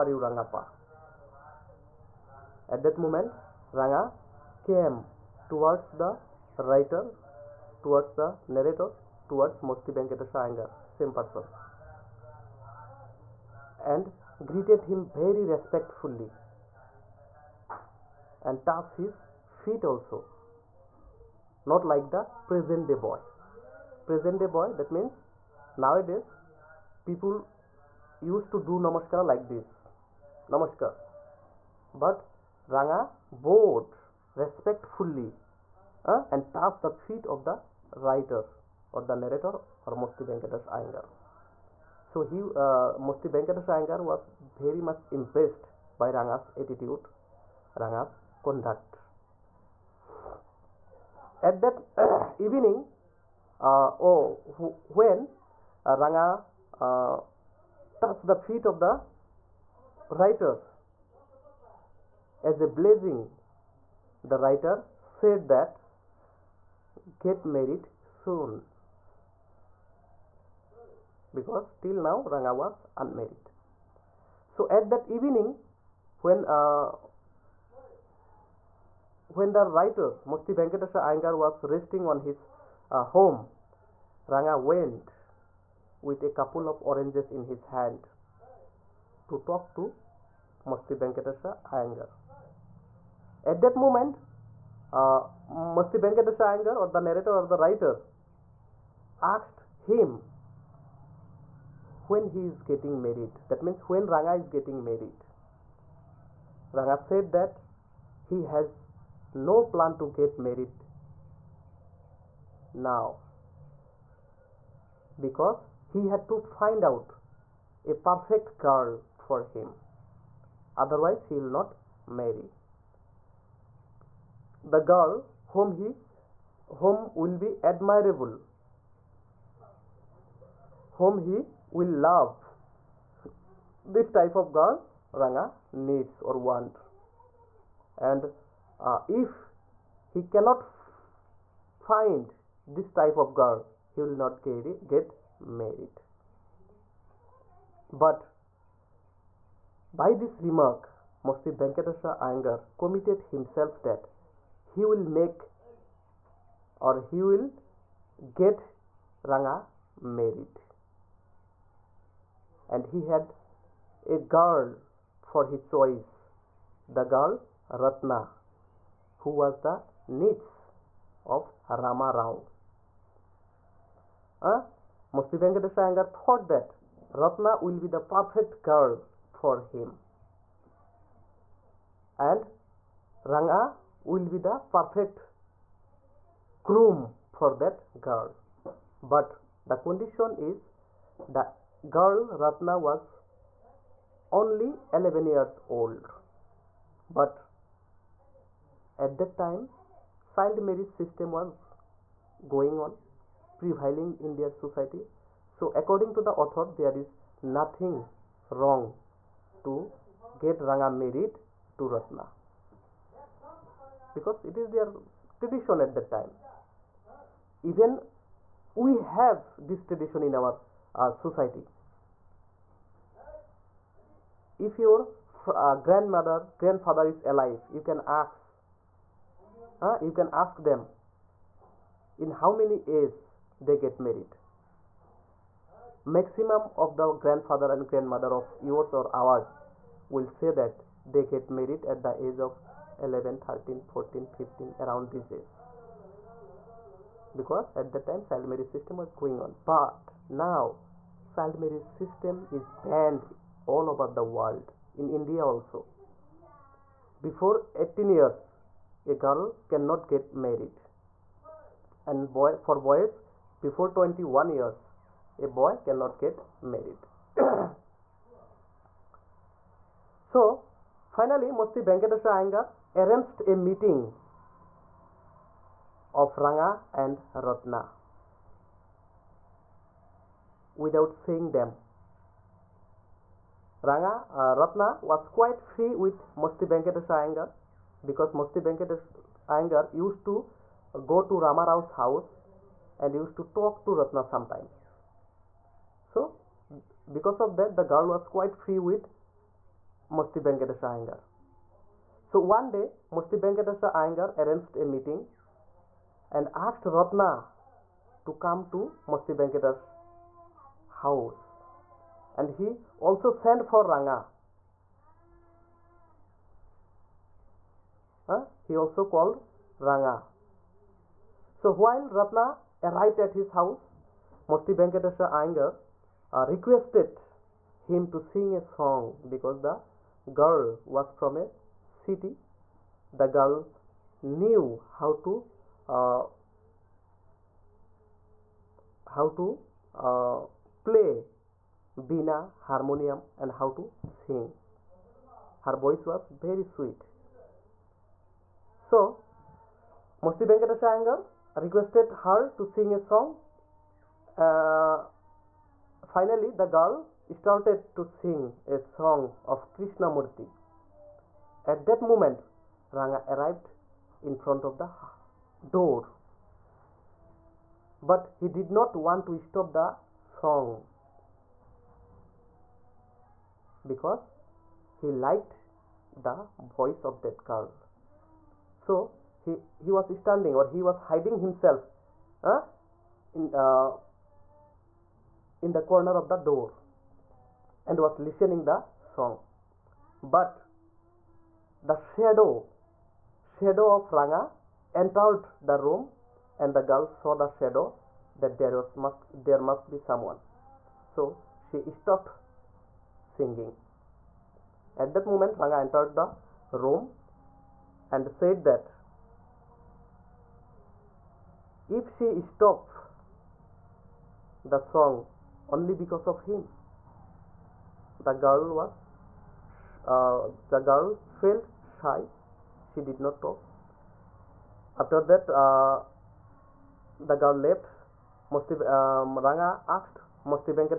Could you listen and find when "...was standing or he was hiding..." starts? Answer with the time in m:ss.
6:19.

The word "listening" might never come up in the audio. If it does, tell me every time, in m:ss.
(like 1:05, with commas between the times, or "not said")
6:28.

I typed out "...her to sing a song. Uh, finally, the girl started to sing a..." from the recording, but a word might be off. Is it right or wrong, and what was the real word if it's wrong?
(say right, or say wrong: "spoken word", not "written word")
right.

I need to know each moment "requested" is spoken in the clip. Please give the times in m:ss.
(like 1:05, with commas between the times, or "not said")
5:26, 5:51.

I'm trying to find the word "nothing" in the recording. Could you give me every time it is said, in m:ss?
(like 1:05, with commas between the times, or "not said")
3:27.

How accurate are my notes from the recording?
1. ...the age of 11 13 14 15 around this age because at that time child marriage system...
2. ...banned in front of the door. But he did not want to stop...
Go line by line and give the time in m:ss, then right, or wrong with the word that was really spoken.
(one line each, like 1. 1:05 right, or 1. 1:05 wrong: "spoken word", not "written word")
1. 4:02 right
2. 6:03 wrong: "arrived", not "banned".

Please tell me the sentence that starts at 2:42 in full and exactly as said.
And he had a girl for his choice, the girl Ratna, who was the niece of Rama Rao.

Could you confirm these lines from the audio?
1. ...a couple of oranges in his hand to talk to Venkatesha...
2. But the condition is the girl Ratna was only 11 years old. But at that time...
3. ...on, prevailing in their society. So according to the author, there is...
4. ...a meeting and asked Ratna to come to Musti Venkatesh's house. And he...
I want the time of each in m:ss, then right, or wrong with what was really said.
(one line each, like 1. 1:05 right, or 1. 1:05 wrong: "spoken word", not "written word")
1. 1:26 wrong: "Musti", not "Venkatesha"
2. 3:09 right
3. 3:22 right
4. 5:04 right.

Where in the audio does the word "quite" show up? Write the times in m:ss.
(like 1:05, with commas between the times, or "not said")
4:45, 4:58.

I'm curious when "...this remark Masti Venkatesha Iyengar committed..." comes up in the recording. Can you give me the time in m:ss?
2:30.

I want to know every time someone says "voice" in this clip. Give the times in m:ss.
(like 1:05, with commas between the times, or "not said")
5:45, 6:16.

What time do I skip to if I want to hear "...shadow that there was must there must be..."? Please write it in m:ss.
6:37.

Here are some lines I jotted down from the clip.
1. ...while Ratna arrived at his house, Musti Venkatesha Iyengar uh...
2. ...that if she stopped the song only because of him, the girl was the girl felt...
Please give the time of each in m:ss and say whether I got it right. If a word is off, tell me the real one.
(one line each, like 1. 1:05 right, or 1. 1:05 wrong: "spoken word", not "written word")
1. 5:21 right
2. 6:48 right.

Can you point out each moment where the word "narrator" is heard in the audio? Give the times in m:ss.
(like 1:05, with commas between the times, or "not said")
0:08, 0:39, 1:37.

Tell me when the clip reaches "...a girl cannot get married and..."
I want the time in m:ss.
4:19.